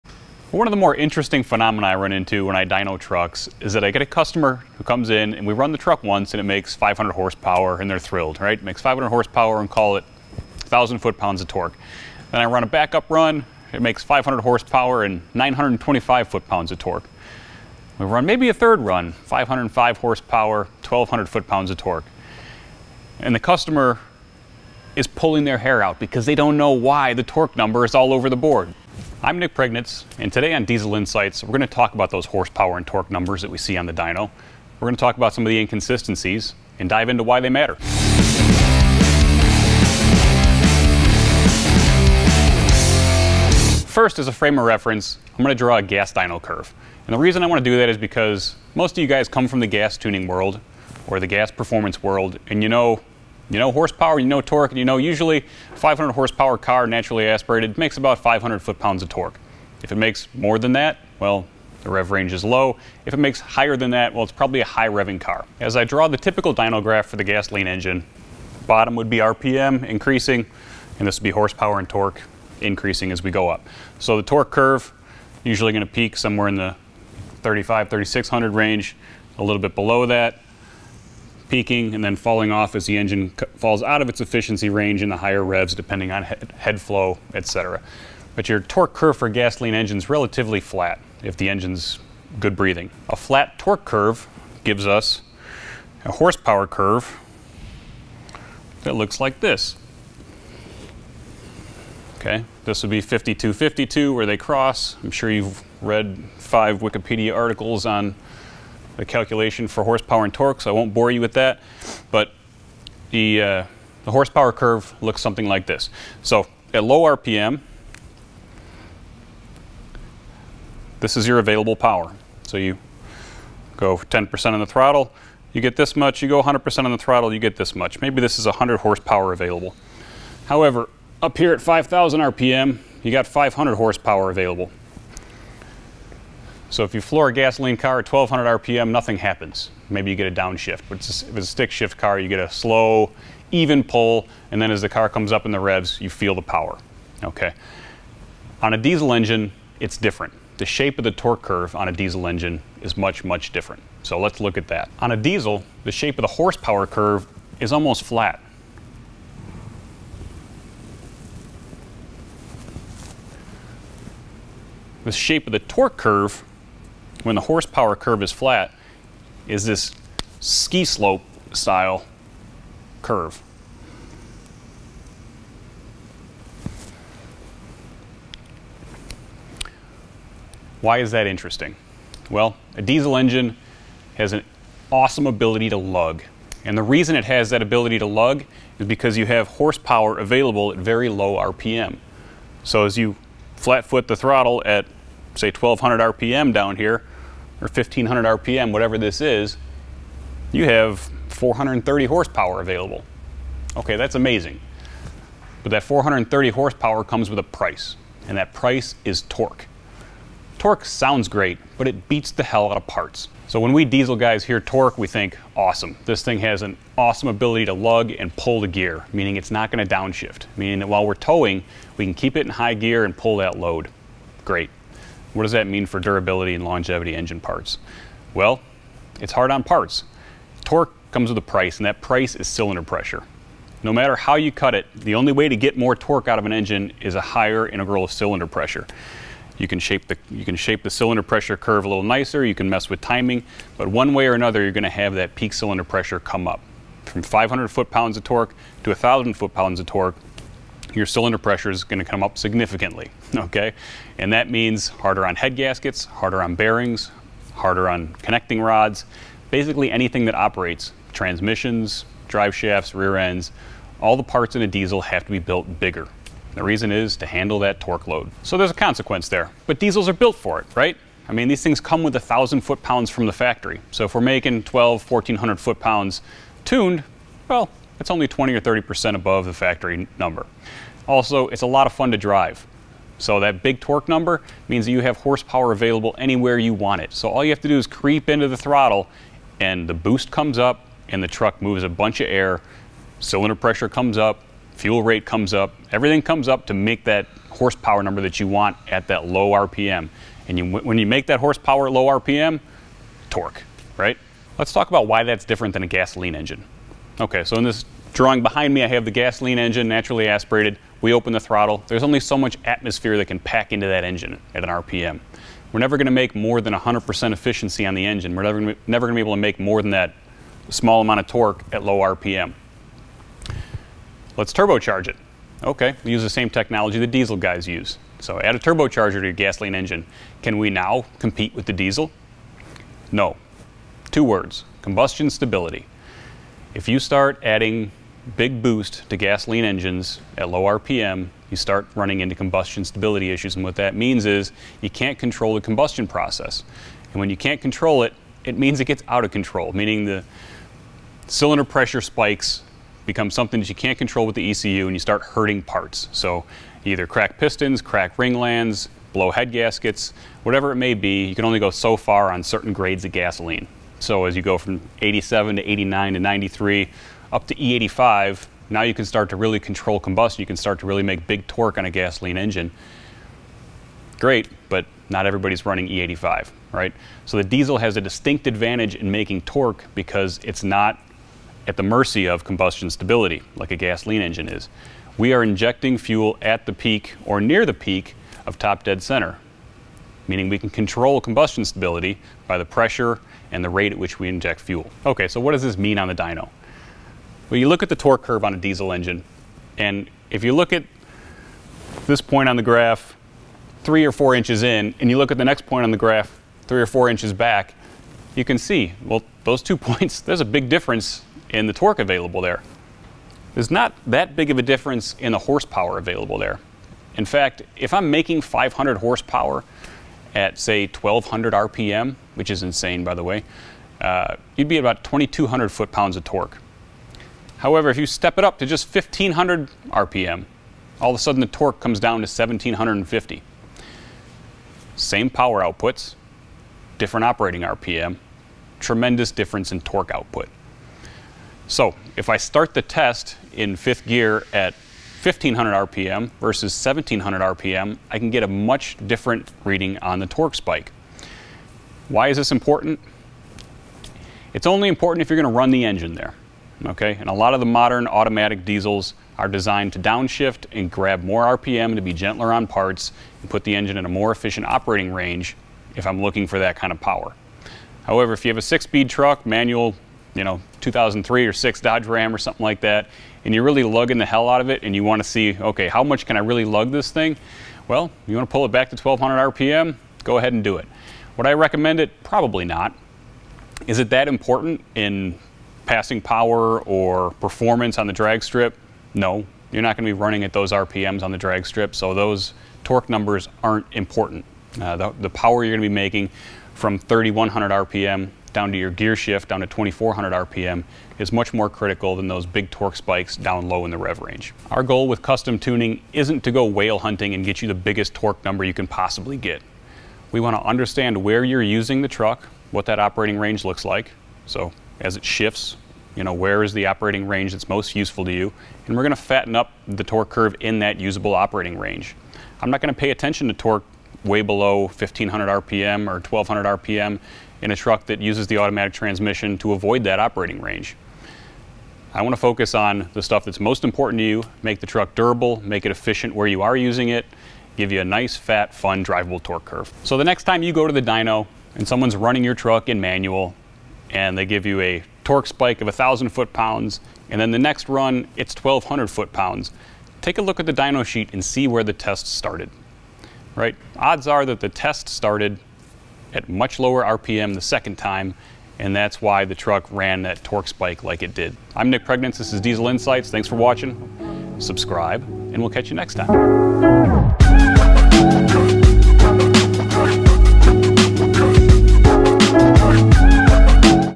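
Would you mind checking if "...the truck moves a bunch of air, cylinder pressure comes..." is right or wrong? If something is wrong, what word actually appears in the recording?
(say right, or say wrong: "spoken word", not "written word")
right.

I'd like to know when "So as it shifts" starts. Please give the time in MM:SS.
08:34.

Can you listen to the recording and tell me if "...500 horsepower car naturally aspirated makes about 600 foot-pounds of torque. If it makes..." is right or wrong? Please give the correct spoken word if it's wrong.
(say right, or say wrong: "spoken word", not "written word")
wrong: "500", not "600".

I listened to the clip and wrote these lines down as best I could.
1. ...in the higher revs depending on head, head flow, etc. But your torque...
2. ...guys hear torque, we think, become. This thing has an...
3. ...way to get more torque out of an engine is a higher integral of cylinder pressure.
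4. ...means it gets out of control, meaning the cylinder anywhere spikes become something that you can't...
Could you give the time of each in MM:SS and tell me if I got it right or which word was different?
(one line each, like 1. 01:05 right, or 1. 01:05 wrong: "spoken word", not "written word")
1. 01:25 right
2. 03:34 wrong: "awesome", not "become"
3. 03:55 right
4. 05:48 wrong: "pressure", not "anywhere".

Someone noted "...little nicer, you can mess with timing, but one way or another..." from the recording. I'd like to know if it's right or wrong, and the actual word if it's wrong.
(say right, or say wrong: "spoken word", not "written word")
right.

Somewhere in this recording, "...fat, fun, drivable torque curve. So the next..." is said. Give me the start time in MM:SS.
08:58.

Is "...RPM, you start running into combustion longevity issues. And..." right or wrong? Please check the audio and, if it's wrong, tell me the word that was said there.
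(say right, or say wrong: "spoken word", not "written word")
wrong: "stability", not "longevity".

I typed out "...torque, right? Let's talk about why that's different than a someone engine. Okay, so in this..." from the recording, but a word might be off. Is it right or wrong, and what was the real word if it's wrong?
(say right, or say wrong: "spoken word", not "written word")
wrong: "gasoline", not "someone".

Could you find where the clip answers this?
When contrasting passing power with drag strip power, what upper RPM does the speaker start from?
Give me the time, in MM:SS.
08:16.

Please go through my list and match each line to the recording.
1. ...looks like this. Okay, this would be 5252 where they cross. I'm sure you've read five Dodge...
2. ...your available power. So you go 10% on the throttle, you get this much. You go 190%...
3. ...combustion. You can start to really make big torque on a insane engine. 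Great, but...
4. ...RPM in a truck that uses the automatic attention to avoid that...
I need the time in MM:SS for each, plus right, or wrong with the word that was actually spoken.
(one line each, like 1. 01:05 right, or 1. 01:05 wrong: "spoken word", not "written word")
1. 01:38 wrong: "Wikipedia", not "Dodge"
2. 02:01 wrong: "100", not "190"
3. 06:09 wrong: "gasoline", not "insane"
4. 08:46 wrong: "transmission", not "attention".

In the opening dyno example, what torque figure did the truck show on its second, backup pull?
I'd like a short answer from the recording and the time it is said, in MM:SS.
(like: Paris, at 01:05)
925 foot-pounds, at 00:15.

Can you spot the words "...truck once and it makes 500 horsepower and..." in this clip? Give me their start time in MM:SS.
00:05.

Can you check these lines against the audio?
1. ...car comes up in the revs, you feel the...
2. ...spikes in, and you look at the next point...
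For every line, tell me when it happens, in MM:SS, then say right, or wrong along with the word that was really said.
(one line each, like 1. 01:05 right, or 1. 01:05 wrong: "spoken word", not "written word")
1. 02:24 right
2. 06:44 wrong: "inches", not "spikes".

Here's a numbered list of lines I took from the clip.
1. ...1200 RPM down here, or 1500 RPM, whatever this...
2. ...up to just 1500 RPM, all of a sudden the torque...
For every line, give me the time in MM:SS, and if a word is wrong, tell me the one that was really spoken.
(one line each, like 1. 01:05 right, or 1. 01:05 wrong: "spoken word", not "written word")
1. 03:15 right
2. 07:08 right.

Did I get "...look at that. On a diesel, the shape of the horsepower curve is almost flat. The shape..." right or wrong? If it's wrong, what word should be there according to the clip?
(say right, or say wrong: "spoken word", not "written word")
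right.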